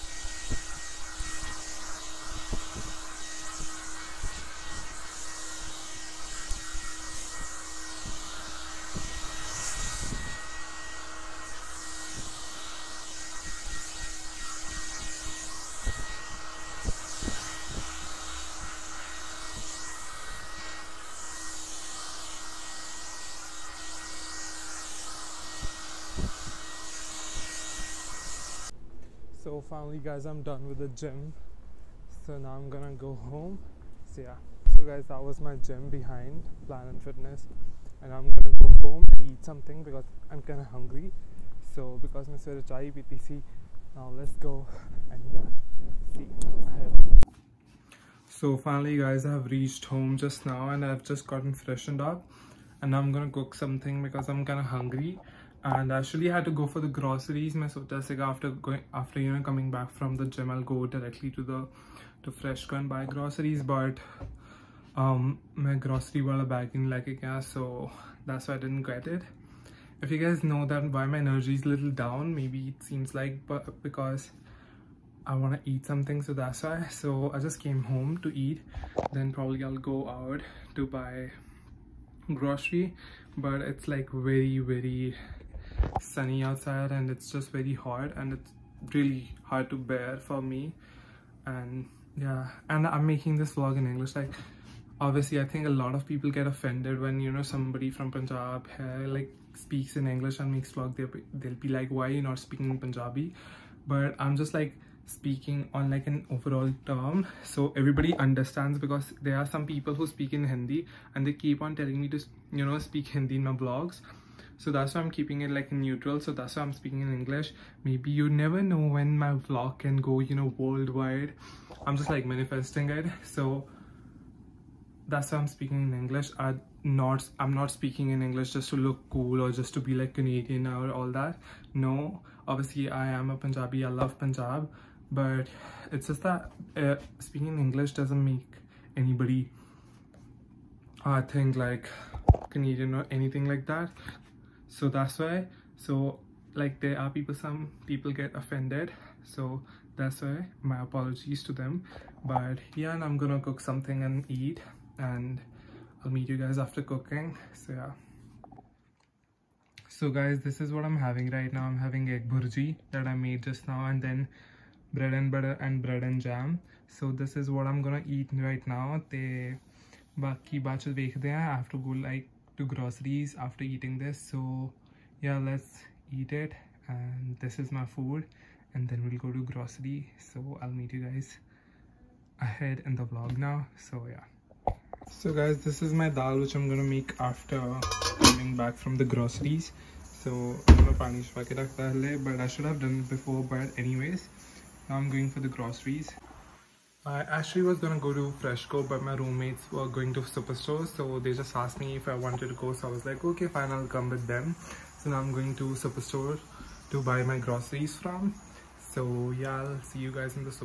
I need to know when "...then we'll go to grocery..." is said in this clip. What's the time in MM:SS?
02:58.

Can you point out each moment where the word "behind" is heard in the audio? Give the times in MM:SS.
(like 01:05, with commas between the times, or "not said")
00:35.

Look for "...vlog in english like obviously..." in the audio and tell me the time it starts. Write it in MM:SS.
01:33.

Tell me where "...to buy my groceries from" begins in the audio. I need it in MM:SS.
03:26.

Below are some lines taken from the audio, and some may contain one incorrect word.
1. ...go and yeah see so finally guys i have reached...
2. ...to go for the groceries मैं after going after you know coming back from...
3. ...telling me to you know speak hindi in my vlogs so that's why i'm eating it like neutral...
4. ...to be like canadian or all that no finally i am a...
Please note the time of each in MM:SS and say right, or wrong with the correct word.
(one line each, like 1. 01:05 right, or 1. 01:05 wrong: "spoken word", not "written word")
1. 00:44 right
2. 00:56 right
3. 01:51 wrong: "keeping", not "eating"
4. 02:09 wrong: "obviously", not "finally".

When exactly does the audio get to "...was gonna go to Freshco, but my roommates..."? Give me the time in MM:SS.
03:17.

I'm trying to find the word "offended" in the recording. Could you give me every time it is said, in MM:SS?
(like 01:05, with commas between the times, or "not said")
01:36, 02:28.